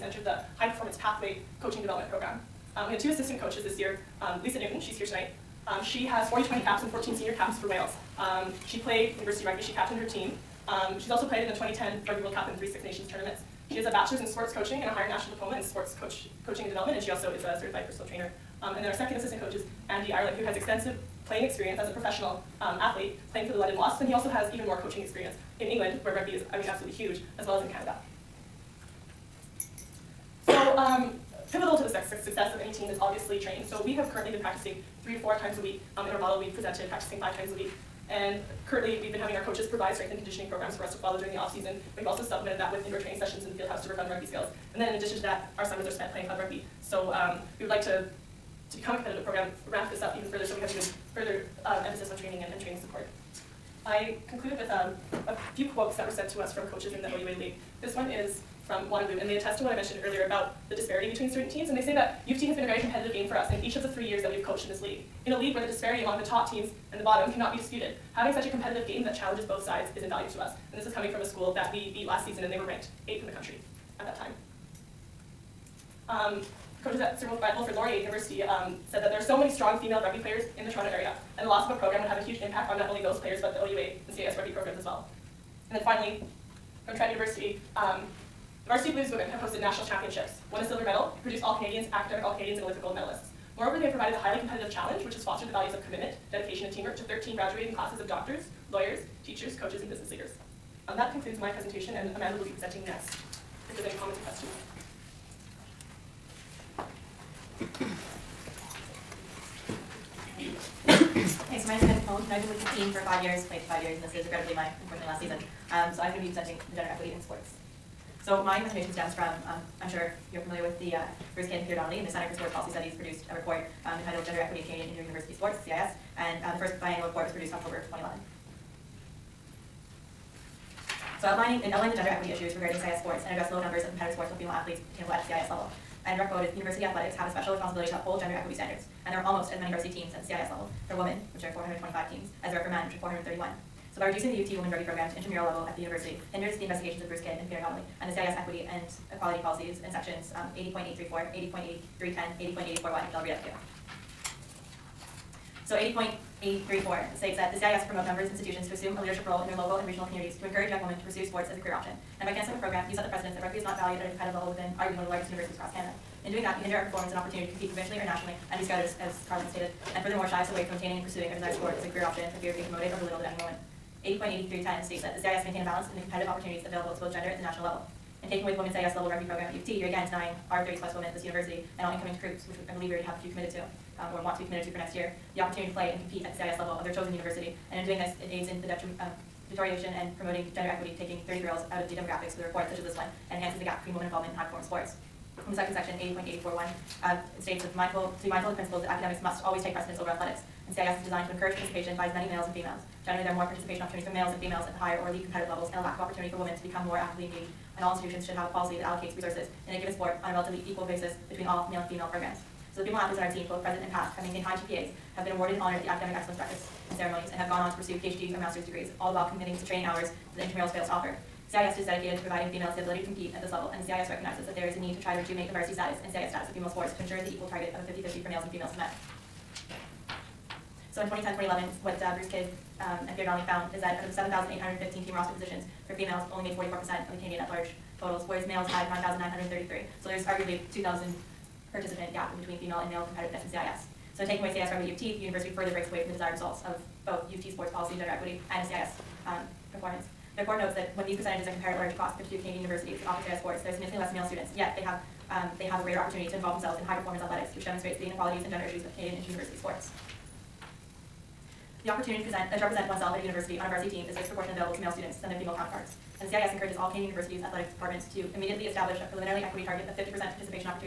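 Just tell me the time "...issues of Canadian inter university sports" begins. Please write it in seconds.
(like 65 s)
258 s.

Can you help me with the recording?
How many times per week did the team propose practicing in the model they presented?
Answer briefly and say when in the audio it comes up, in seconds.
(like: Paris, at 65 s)
5, at 37 s.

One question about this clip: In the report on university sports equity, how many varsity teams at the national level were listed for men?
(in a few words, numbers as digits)
431.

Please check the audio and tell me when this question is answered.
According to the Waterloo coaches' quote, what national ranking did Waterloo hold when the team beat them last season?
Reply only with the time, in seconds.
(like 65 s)
73 s.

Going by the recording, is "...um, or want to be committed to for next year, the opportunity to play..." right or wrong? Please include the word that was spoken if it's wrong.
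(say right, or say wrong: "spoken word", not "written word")
right.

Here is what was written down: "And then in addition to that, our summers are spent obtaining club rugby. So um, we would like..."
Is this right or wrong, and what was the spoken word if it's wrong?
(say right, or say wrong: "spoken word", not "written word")
wrong: "playing", not "obtaining".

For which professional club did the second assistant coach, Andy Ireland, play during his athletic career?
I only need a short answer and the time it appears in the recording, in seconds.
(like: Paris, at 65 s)
London Wasps, at 23 s.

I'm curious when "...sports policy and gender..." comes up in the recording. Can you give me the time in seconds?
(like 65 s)
247 s.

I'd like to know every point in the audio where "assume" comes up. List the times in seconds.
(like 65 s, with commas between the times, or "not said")
158 s.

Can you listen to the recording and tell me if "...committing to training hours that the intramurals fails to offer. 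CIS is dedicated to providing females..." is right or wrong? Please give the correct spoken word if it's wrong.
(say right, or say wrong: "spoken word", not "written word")
right.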